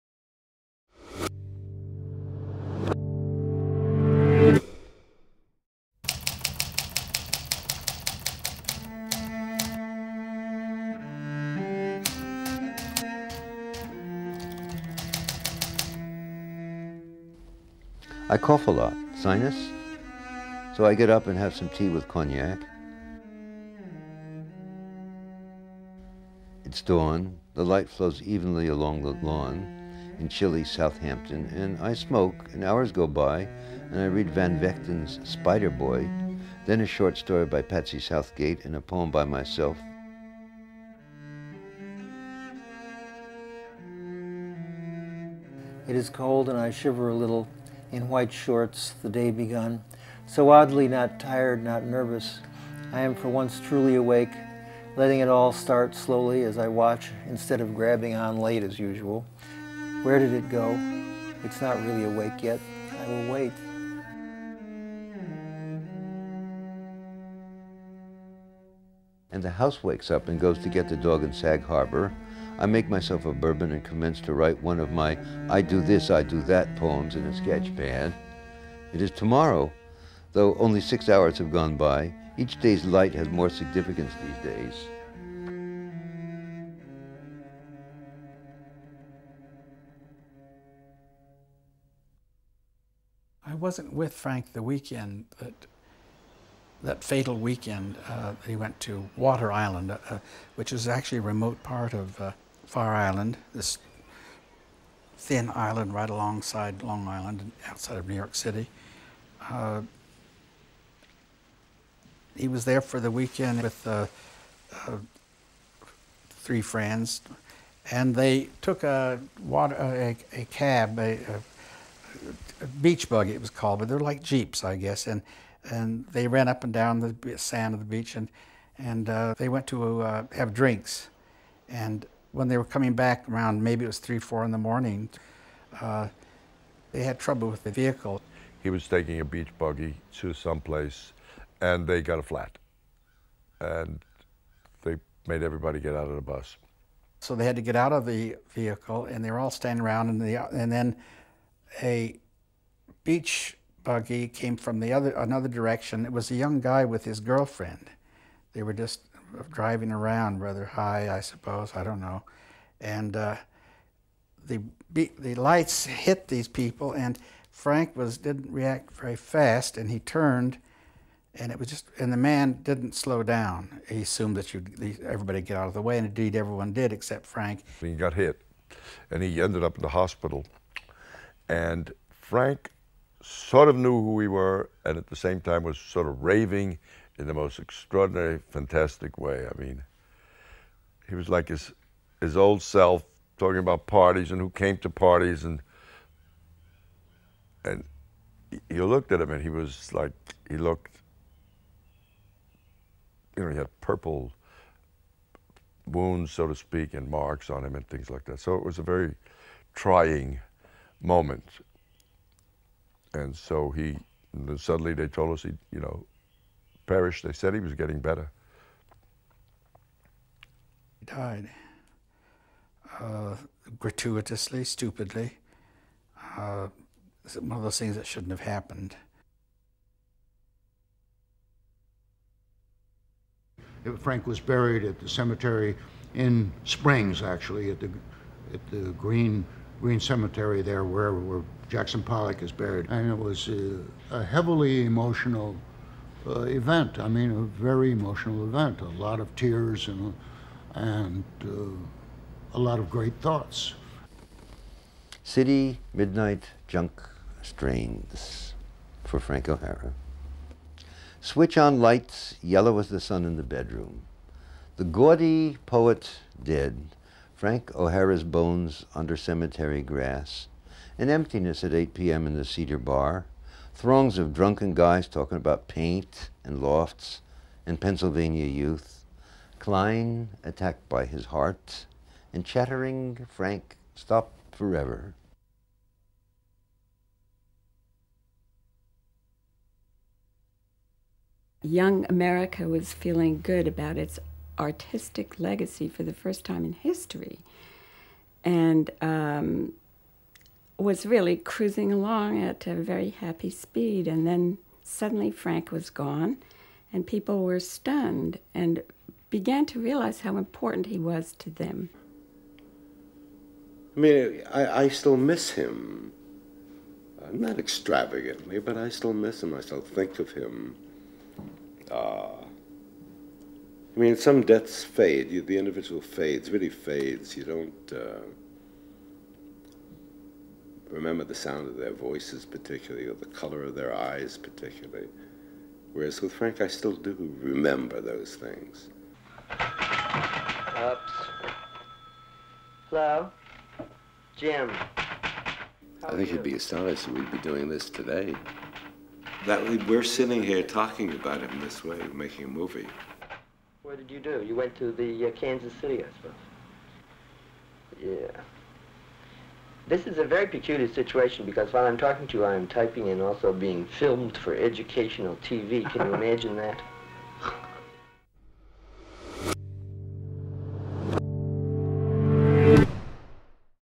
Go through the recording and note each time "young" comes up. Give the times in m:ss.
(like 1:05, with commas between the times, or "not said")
2:36, 4:51.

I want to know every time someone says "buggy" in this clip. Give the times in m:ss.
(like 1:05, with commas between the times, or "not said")
2:03, 2:19, 2:33.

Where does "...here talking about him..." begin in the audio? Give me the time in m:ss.
5:50.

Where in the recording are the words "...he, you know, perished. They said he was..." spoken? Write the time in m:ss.
3:35.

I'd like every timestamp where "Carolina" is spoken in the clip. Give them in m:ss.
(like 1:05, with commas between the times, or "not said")
not said.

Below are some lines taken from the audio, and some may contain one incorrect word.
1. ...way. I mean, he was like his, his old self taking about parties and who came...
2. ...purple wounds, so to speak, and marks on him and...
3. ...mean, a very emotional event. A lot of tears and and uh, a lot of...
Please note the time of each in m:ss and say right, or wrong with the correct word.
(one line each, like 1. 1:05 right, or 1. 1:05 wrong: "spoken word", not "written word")
1. 3:09 wrong: "talking", not "taking"
2. 3:23 right
3. 4:07 right.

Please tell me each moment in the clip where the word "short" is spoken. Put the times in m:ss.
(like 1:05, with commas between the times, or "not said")
0:36, 0:48.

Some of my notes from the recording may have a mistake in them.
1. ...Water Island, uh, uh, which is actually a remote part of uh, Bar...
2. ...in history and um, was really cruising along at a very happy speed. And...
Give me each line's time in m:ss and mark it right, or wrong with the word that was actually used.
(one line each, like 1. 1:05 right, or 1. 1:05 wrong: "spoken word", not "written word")
1. 1:39 wrong: "Fire", not "Bar"
2. 4:56 right.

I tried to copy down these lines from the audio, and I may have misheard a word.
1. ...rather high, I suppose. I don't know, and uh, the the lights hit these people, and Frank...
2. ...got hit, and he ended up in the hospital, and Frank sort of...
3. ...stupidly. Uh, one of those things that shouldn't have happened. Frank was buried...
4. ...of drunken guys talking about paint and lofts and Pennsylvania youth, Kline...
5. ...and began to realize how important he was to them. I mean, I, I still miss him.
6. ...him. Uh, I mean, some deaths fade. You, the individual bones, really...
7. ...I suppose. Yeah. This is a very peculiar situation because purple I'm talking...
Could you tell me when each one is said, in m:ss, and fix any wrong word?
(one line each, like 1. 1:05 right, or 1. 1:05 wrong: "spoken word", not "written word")
1. 2:40 right
2. 2:57 right
3. 3:44 right
4. 4:34 right
5. 5:08 right
6. 5:20 wrong: "fades", not "bones"
7. 5:56 wrong: "while", not "purple".